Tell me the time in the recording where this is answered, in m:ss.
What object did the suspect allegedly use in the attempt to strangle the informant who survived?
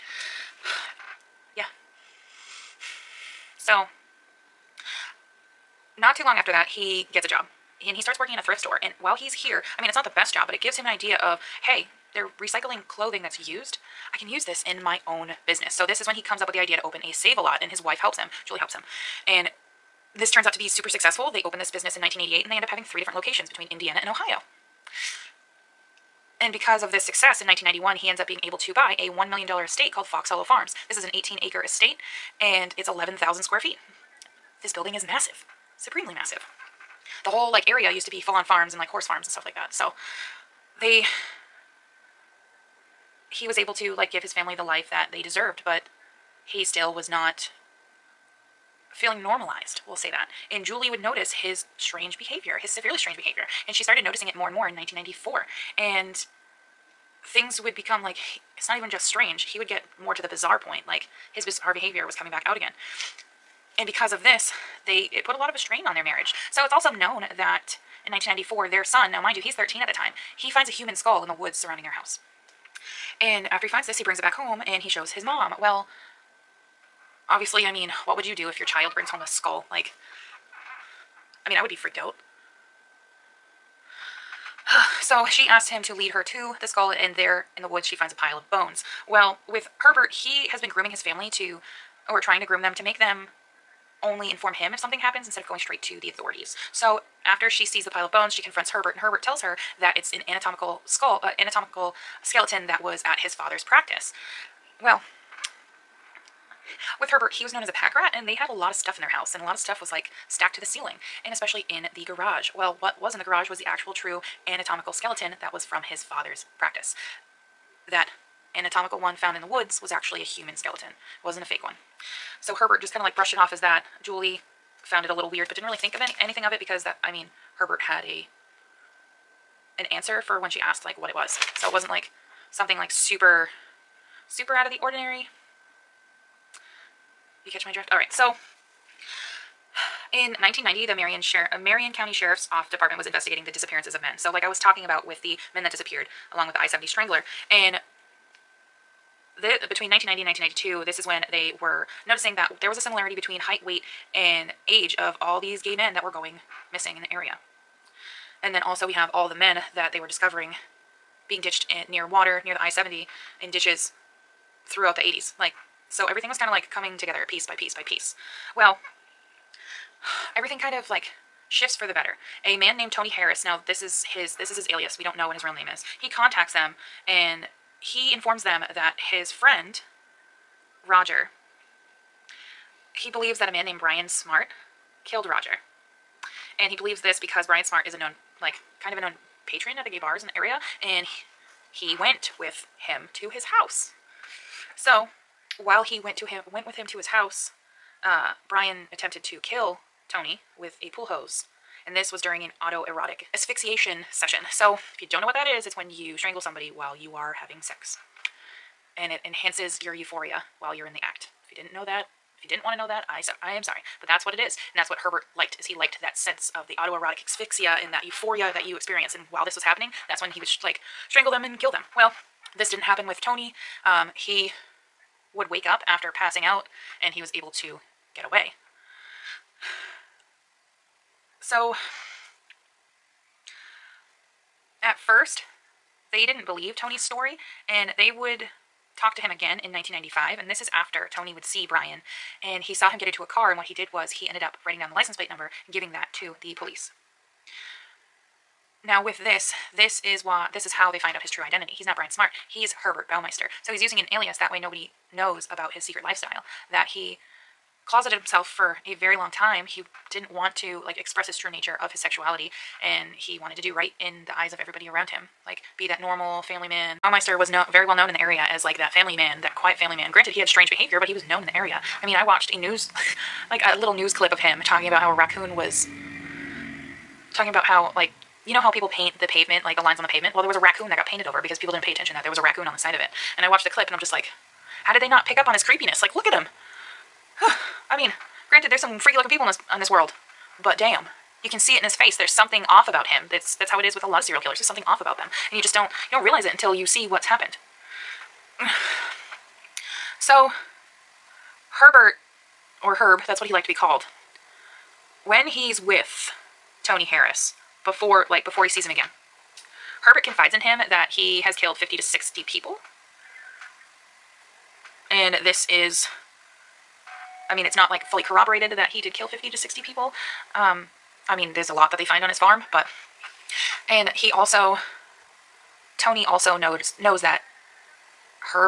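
3:20.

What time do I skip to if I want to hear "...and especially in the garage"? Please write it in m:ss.
1:51.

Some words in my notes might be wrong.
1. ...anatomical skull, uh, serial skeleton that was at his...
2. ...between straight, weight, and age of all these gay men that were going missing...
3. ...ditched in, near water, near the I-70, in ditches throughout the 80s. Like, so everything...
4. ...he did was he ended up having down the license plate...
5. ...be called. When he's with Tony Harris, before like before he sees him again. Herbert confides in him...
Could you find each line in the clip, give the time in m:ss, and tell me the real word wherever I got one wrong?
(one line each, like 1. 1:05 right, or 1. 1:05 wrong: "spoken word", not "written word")
1. 1:40 wrong: "anatomical", not "serial"
2. 2:33 wrong: "height", not "straight"
3. 2:41 right
4. 4:03 wrong: "writing", not "having"
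5. 5:03 right.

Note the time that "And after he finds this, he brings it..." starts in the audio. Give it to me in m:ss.
1:13.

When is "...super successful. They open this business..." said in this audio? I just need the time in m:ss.
0:20.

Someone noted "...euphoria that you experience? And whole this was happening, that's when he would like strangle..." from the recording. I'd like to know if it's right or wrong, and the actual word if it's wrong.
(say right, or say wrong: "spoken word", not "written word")
wrong: "while", not "whole".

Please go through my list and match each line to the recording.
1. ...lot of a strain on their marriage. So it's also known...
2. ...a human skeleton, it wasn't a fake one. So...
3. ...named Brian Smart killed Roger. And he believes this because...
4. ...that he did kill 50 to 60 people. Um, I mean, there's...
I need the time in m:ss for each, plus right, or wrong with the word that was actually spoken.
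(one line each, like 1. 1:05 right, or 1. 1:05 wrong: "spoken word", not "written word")
1. 1:05 right
2. 2:00 right
3. 3:03 right
4. 5:18 right.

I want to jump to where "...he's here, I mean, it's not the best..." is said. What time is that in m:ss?
0:09.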